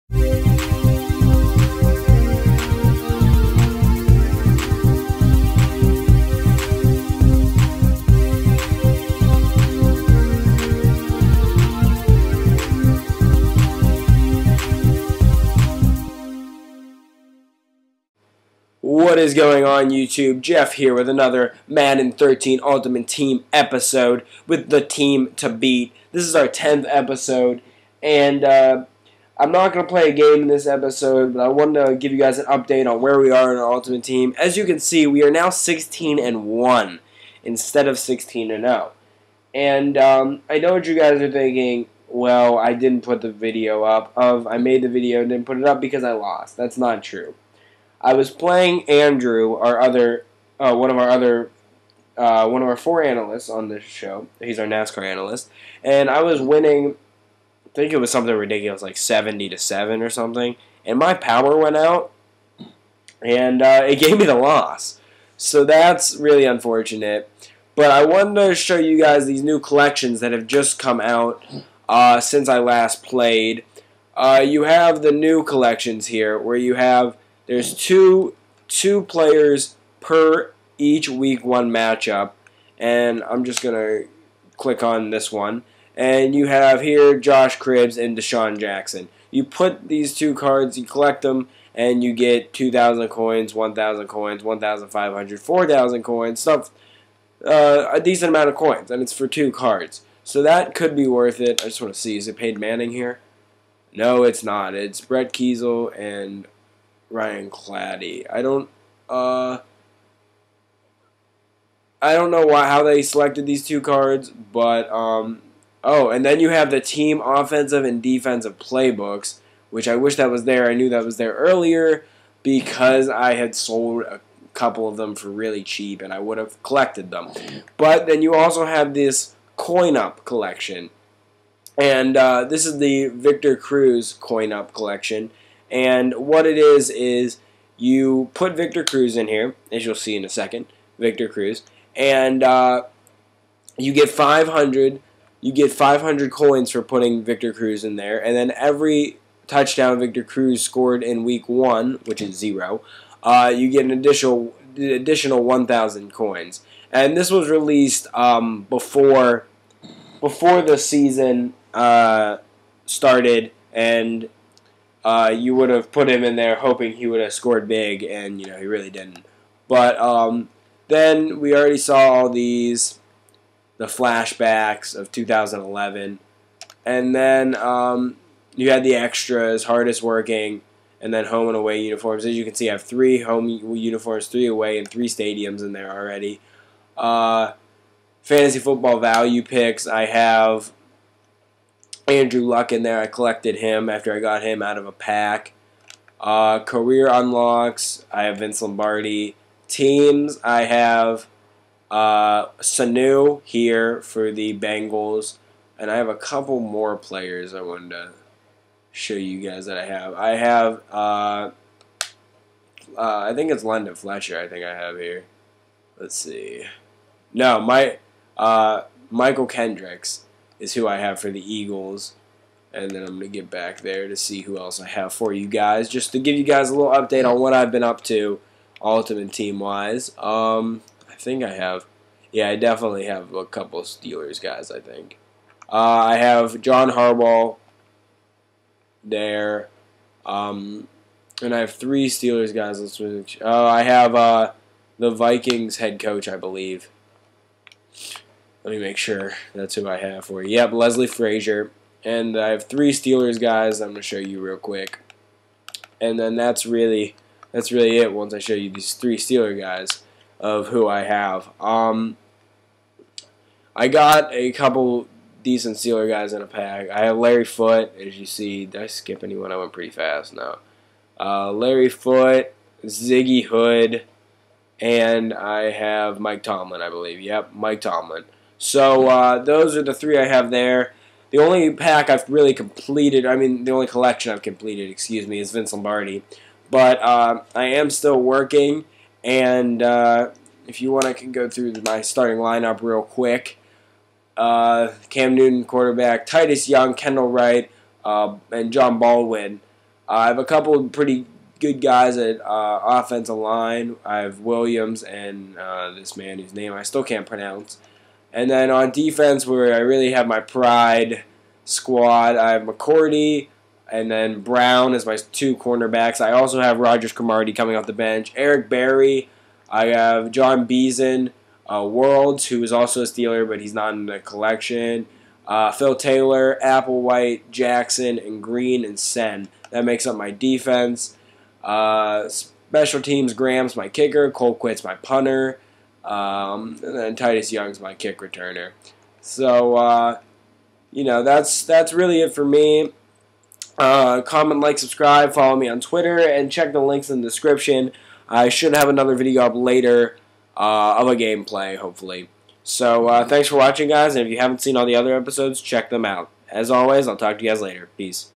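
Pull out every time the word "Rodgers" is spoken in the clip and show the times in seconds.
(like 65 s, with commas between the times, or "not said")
316 s.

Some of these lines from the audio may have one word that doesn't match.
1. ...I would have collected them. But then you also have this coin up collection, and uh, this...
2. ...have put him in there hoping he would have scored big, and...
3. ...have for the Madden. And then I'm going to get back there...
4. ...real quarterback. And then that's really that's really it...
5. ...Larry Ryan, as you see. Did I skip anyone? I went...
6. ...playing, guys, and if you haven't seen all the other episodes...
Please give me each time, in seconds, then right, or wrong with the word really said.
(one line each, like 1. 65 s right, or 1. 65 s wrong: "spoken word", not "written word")
1. 126 s right
2. 165 s right
3. 220 s wrong: "Eagles", not "Madden"
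4. 254 s wrong: "quick", not "quarterback"
5. 267 s wrong: "Foote", not "Ryan"
6. 353 s wrong: "watching", not "playing".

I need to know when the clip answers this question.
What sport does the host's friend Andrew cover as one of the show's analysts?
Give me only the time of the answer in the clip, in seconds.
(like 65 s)
54 s.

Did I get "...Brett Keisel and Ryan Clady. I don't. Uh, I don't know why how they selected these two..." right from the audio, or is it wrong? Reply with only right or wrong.
right.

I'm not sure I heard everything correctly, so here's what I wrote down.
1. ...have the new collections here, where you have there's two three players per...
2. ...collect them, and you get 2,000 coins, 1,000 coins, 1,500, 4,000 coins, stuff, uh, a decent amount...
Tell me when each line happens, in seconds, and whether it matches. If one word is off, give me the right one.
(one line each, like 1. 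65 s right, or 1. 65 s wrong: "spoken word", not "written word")
1. 74 s wrong: "two", not "three"
2. 90 s right.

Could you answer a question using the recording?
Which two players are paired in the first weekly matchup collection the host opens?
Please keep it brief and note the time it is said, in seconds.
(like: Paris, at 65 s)
Josh Cribbs and DeSean Jackson, at 87 s.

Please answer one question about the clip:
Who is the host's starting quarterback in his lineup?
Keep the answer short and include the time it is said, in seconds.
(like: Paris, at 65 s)
Cam Newton, at 295 s.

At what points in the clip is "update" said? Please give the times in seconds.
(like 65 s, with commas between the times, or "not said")
32 s, 226 s.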